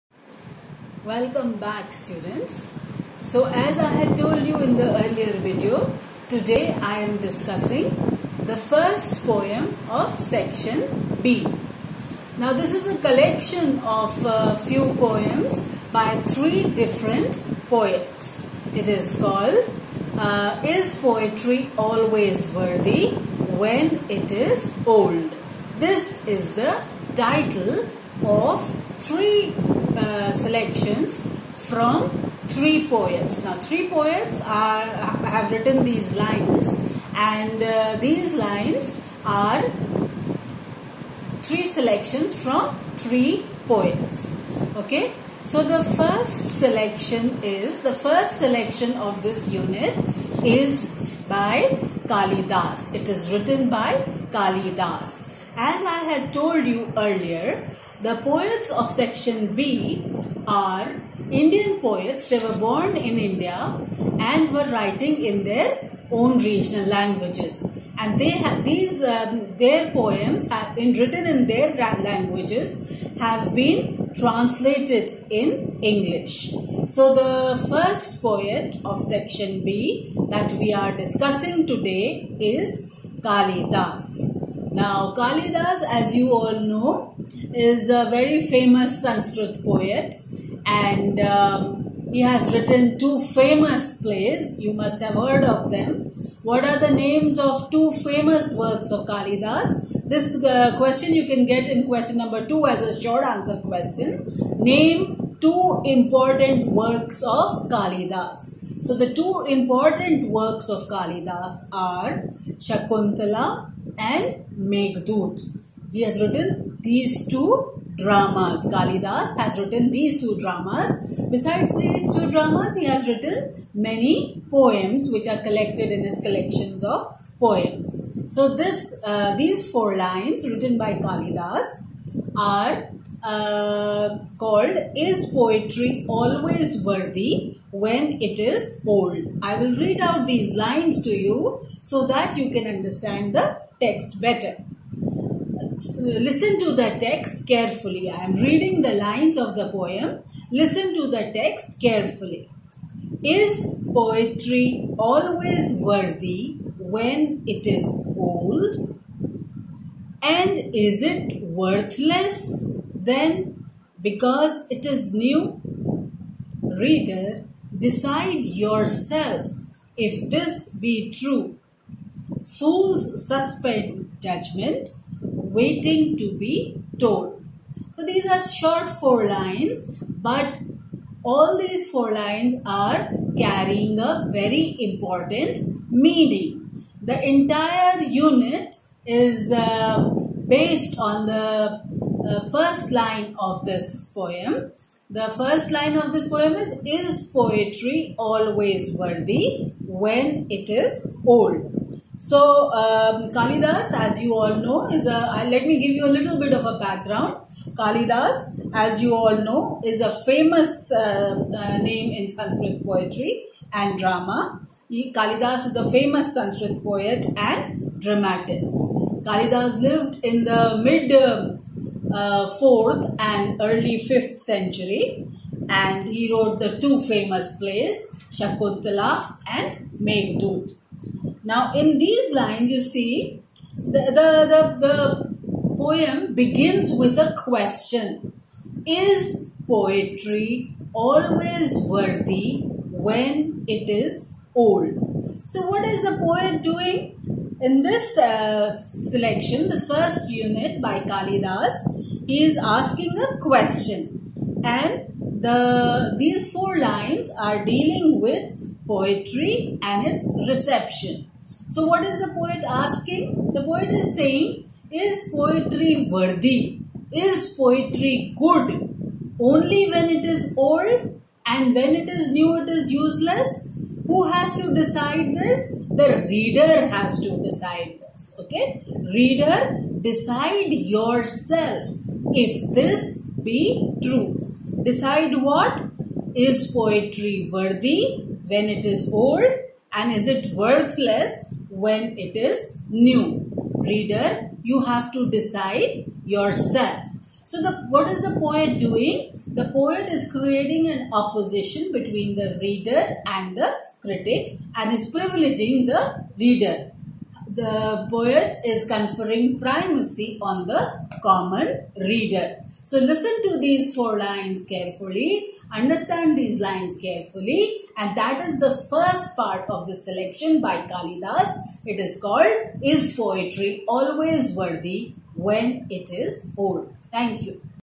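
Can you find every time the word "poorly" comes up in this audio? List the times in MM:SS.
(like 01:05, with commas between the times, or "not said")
not said.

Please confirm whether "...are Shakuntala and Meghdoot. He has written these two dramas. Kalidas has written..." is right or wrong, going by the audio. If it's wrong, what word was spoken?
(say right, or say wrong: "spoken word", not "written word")
right.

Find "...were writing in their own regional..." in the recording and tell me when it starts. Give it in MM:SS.
01:04.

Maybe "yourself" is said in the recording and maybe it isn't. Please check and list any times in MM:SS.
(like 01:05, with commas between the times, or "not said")
02:48, 04:40, 04:56.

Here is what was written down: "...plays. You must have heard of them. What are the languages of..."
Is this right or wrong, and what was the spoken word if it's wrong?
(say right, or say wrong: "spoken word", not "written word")
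wrong: "names", not "languages".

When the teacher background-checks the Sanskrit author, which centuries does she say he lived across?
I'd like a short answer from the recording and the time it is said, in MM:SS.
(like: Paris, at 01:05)
mid 4th and early 5th century, at 03:40.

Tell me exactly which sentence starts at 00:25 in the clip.
This is the title of three uh, selections from three poets.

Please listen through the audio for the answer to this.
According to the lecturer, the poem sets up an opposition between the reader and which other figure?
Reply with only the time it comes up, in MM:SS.
05:03.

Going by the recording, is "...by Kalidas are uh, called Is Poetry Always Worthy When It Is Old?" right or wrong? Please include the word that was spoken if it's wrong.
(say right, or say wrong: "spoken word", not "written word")
right.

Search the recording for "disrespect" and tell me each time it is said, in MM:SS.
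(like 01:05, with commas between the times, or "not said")
not said.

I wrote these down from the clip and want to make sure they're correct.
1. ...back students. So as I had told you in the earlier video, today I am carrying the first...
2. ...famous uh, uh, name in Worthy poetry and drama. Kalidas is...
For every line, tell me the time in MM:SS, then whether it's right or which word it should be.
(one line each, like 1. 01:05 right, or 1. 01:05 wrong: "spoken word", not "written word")
1. 00:01 wrong: "discussing", not "carrying"
2. 03:30 wrong: "Sanskrit", not "Worthy".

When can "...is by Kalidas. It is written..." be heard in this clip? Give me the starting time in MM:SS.
00:50.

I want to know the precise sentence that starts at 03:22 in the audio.
So um, Kalidas, as you all know, is a, uh, let me give you a little bit of a background.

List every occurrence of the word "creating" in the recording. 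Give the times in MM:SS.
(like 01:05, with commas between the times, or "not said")
05:00.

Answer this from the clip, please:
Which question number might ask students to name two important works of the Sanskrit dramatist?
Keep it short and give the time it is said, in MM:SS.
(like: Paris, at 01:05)
2, at 01:41.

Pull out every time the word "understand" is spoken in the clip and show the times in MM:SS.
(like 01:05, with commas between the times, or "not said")
02:22, 05:15.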